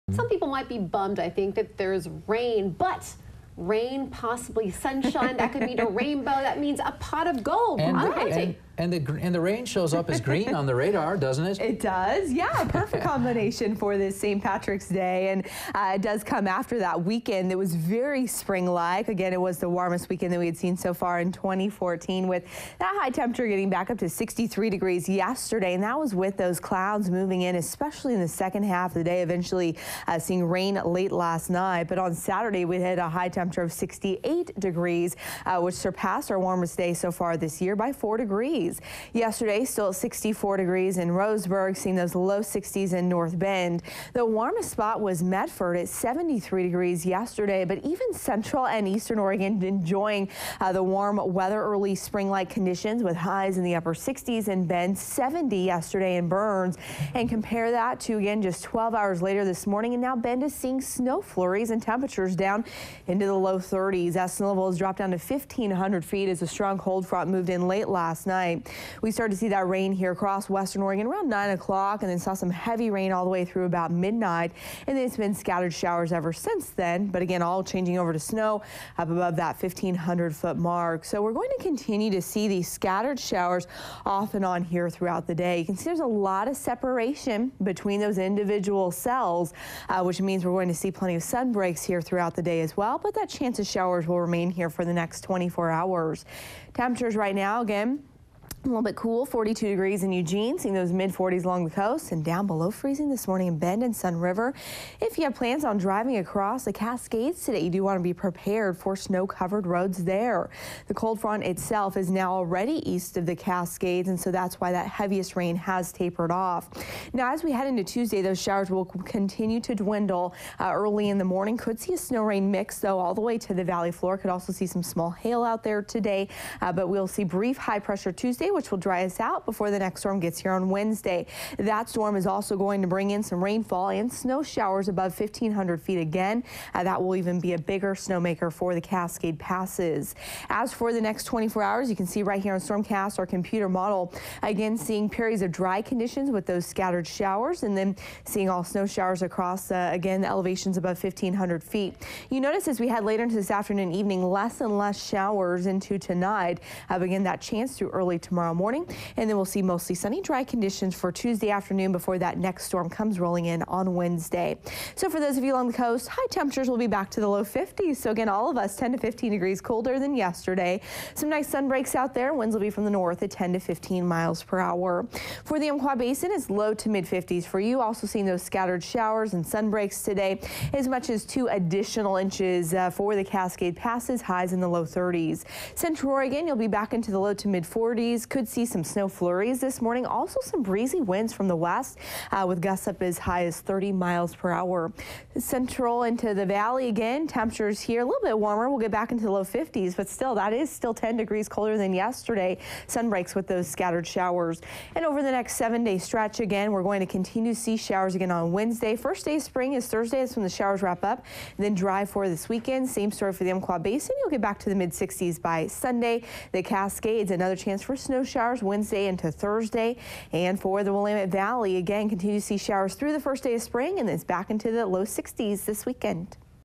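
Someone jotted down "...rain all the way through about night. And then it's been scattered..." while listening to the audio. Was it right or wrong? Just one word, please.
wrong.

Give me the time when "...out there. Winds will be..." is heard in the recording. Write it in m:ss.
2:51.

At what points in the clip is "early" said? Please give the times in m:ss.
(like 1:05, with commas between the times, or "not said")
0:51, 2:00, 2:37.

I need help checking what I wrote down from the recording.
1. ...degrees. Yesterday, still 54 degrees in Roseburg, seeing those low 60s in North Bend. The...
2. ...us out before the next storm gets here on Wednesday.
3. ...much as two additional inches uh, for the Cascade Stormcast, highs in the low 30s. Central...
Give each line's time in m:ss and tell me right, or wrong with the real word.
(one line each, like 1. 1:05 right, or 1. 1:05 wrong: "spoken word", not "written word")
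1. 0:38 wrong: "64", not "54"
2. 2:09 right
3. 3:00 wrong: "Passes", not "Stormcast".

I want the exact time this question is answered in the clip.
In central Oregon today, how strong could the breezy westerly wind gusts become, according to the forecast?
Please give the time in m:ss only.
3:13.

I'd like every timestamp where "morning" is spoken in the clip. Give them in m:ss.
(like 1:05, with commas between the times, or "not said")
0:59, 1:43, 2:01, 2:38, 3:09.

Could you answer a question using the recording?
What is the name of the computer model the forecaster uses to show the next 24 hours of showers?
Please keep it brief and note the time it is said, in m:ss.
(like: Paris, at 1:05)
Stormcast, at 2:22.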